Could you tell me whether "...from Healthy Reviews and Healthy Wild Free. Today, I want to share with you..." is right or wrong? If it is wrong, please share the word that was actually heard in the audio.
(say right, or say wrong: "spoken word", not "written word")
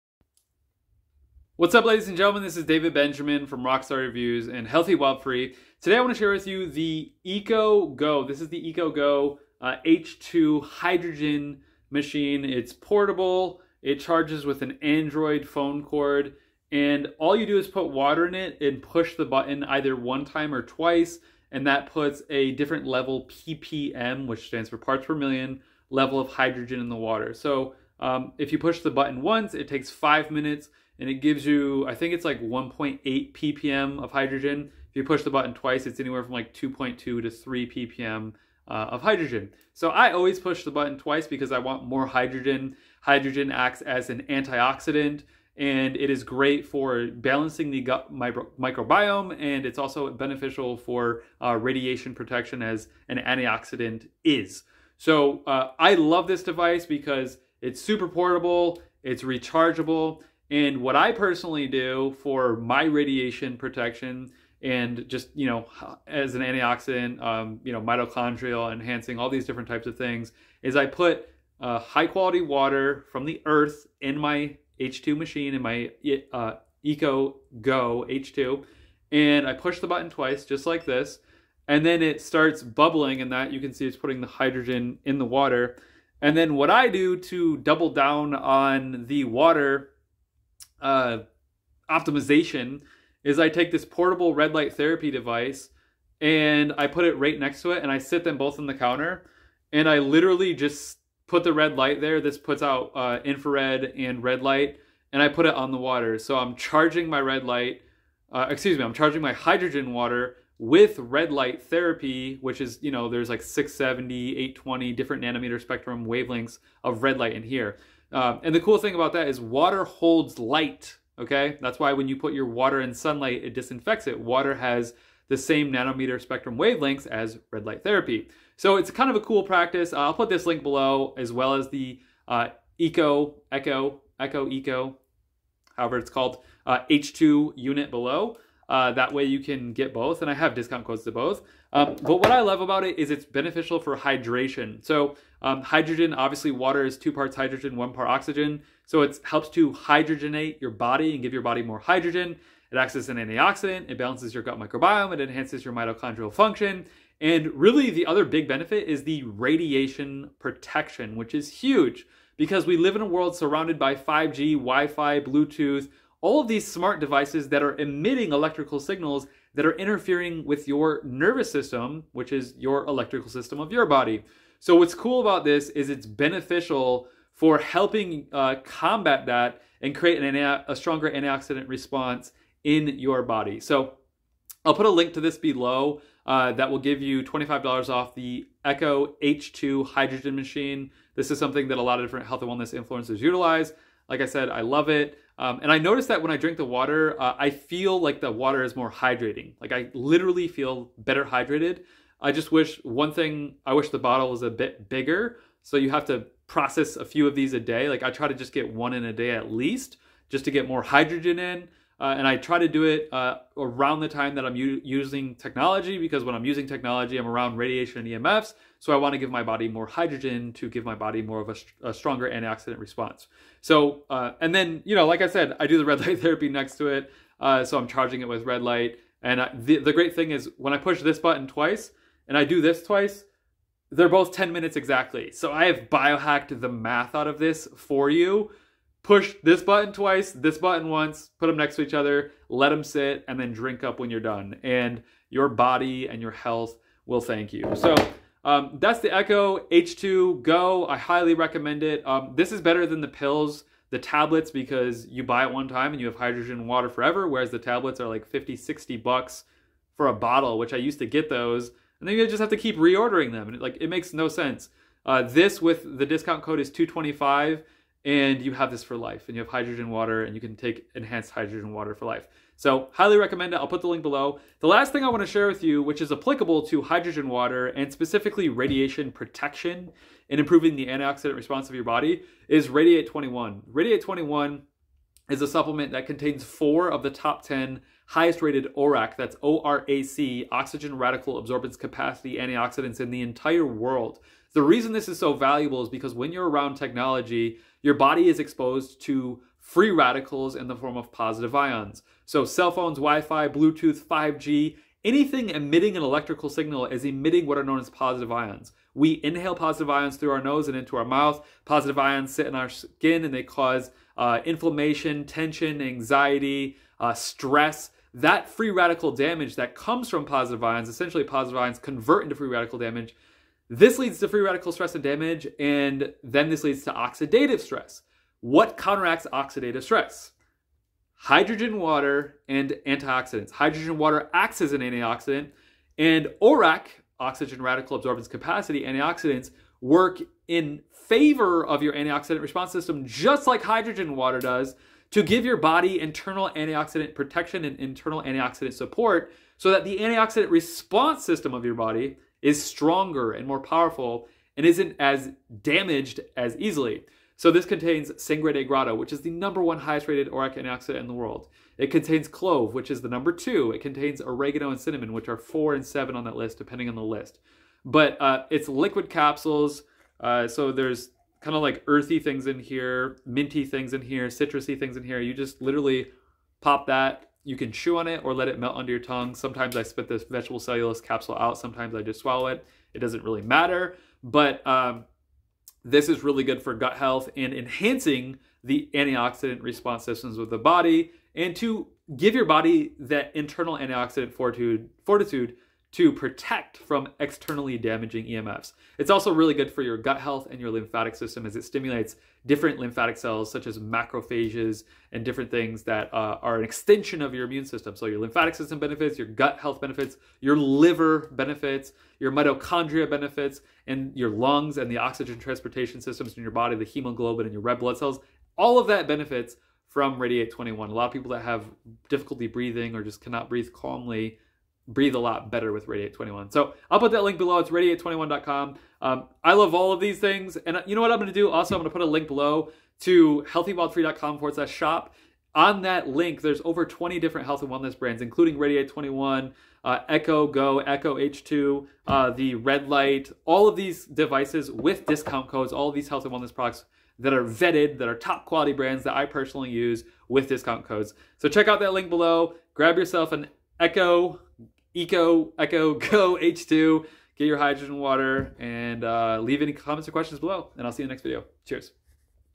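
wrong: "Rockstar", not "Healthy".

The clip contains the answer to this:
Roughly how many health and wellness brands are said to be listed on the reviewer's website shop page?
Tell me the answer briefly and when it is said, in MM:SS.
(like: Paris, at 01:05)
Over 20, at 07:16.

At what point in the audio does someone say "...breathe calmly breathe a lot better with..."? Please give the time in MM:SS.
07:03.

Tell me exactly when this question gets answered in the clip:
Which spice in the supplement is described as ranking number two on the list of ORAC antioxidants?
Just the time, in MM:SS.
06:02.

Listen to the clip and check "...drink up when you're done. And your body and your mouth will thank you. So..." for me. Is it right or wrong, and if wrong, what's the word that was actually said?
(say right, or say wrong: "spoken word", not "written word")
wrong: "health", not "mouth".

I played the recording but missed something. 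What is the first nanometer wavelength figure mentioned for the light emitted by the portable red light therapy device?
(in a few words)
670.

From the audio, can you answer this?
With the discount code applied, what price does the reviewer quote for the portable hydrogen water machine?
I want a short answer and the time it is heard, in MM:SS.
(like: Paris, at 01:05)
225, at 04:26.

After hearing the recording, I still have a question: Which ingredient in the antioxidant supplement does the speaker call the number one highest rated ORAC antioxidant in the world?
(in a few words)
Sangre de Grado.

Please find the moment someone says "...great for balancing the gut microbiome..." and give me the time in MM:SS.
00:46.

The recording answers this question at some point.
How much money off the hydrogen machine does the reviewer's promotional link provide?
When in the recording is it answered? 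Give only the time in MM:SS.
03:07.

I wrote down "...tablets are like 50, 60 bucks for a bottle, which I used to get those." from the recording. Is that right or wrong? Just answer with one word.
right.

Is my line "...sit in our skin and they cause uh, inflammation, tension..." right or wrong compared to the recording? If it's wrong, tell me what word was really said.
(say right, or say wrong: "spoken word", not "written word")
right.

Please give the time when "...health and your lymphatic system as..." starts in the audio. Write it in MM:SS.
06:40.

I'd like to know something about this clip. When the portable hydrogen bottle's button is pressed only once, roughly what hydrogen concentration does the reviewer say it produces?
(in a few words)
1.8 ppm.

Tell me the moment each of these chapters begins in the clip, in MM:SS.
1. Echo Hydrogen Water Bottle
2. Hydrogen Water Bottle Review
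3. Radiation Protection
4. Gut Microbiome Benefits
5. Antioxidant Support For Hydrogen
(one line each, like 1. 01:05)
1. 01:10
2. 02:00
3. 03:00
4. 04:00
5. 05:00.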